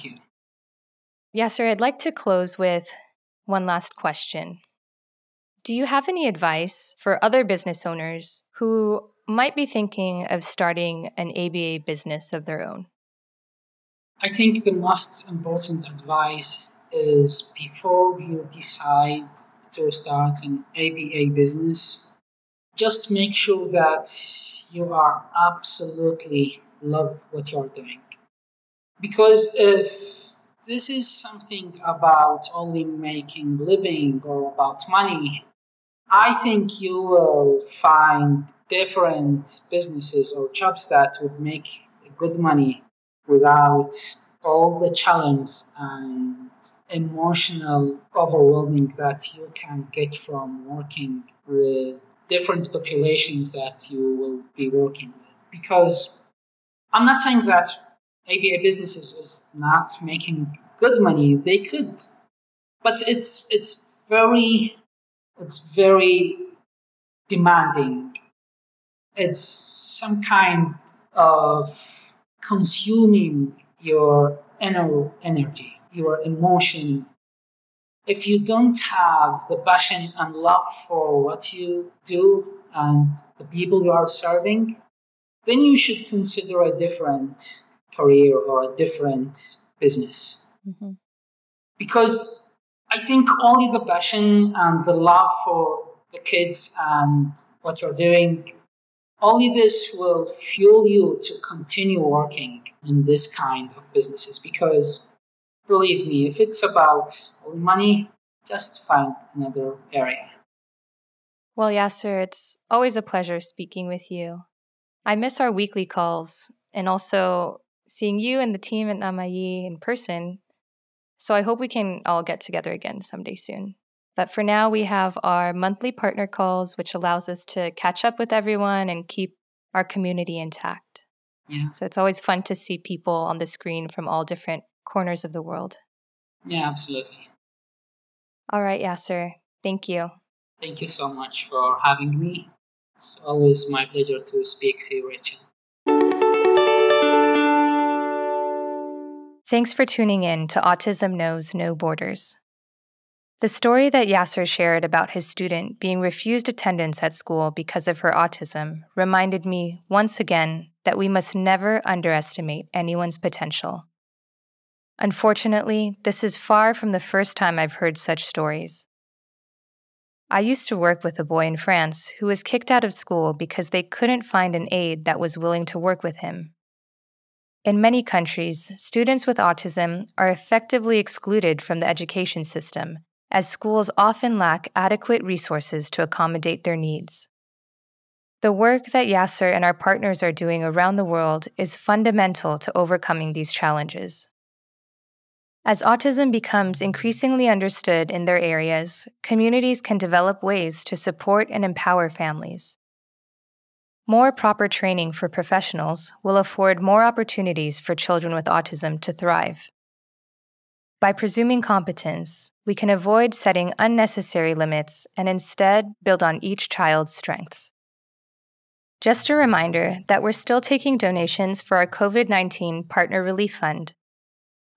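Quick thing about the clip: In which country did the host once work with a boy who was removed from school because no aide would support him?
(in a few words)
France.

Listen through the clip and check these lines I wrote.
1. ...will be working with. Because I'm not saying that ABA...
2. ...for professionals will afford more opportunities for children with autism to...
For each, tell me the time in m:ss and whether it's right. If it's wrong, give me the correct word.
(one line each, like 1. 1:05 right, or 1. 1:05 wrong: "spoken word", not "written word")
1. 0:54 right
2. 3:25 right.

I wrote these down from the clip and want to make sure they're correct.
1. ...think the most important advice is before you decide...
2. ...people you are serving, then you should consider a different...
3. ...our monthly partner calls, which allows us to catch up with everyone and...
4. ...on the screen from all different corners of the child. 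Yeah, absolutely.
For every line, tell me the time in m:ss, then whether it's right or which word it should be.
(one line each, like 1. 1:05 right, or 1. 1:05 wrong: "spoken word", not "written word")
1. 0:14 right
2. 1:23 right
3. 2:05 right
4. 2:13 wrong: "world", not "child".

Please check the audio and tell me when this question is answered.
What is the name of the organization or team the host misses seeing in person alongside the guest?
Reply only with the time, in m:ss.
1:58.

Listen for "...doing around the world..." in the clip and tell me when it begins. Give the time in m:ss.
3:10.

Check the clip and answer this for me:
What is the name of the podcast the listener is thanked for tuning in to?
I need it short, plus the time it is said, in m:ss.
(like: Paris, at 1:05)
Autism Knows No Borders, at 2:30.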